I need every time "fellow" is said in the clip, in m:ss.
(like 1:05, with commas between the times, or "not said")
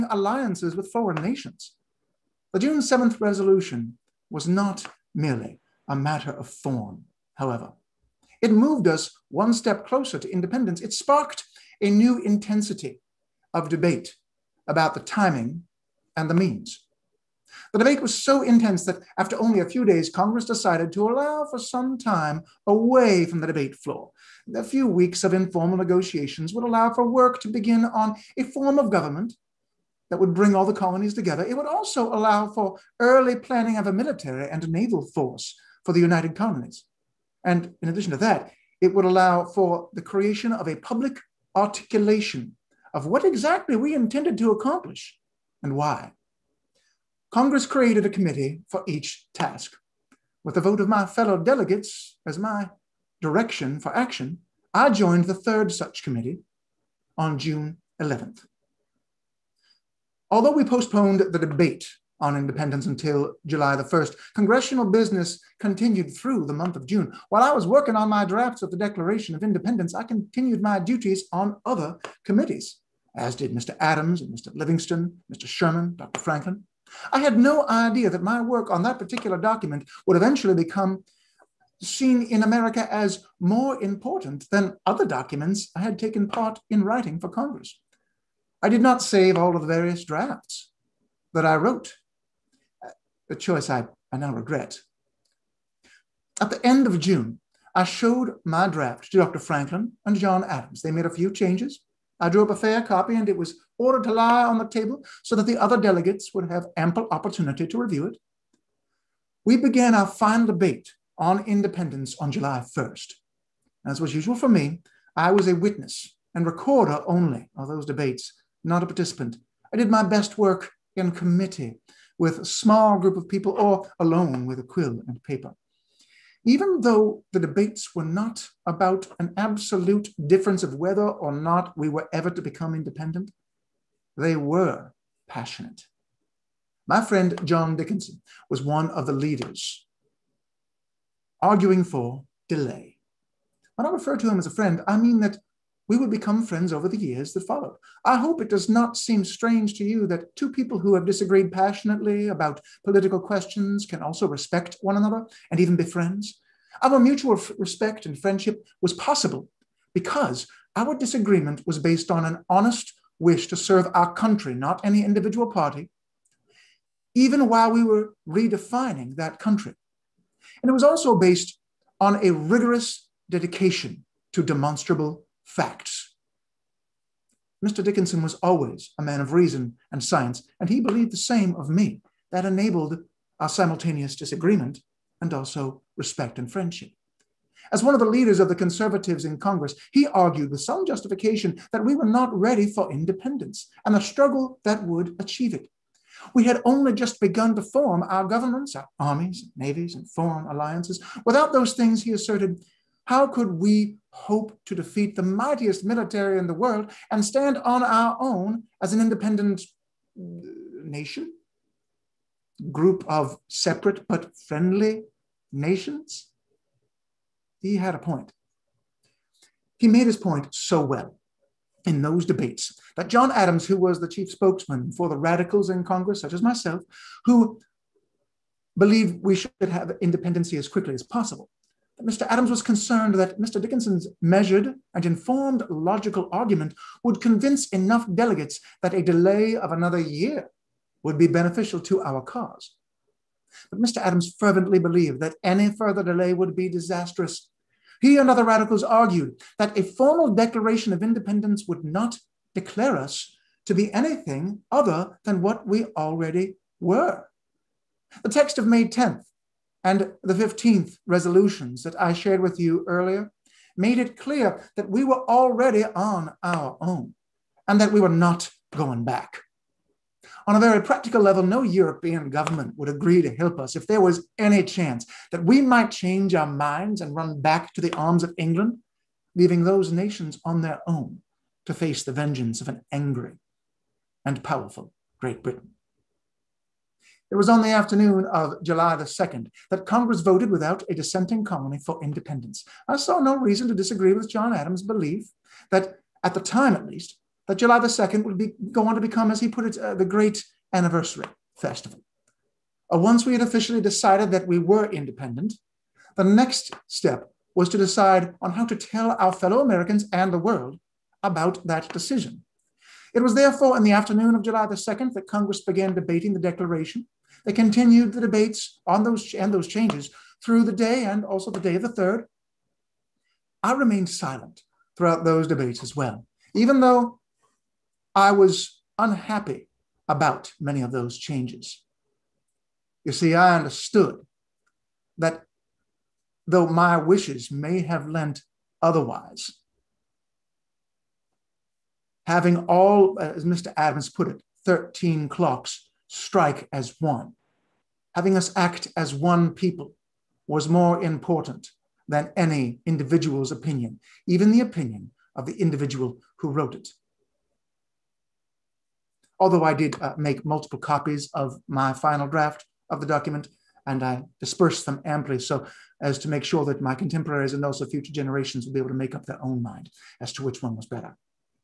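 0:51, 5:09.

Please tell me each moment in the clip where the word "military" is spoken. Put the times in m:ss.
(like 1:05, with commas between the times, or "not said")
0:33, 3:25.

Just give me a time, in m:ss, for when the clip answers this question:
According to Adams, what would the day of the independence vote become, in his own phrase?
4:59.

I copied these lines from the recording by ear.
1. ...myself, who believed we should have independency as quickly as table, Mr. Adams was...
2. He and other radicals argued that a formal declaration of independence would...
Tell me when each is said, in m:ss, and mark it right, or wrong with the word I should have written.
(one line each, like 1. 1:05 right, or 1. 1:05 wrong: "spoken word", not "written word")
1. 3:46 wrong: "possible", not "table"
2. 4:07 right.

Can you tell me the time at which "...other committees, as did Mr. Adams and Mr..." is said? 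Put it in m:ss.
1:11.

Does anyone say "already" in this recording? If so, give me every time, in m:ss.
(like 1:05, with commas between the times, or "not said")
4:15, 4:25.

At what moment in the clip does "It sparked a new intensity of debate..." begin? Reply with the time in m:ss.
0:10.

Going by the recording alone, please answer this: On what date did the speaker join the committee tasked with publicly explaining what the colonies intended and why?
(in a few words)
June 11th.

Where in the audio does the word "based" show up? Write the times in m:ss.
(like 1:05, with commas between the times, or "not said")
2:41, 2:51.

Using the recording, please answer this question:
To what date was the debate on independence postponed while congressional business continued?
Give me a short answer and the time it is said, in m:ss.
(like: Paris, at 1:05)
July 1st, at 1:03.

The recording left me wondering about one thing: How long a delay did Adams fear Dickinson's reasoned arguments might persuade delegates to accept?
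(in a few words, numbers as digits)
another year.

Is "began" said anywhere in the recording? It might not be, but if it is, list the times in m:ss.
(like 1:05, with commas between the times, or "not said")
1:49, 5:15.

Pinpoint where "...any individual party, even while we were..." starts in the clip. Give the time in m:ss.
2:44.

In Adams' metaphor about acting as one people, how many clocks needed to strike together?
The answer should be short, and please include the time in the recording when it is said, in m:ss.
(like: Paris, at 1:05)
13, at 5:44.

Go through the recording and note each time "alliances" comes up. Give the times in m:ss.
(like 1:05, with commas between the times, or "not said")
0:00, 3:20.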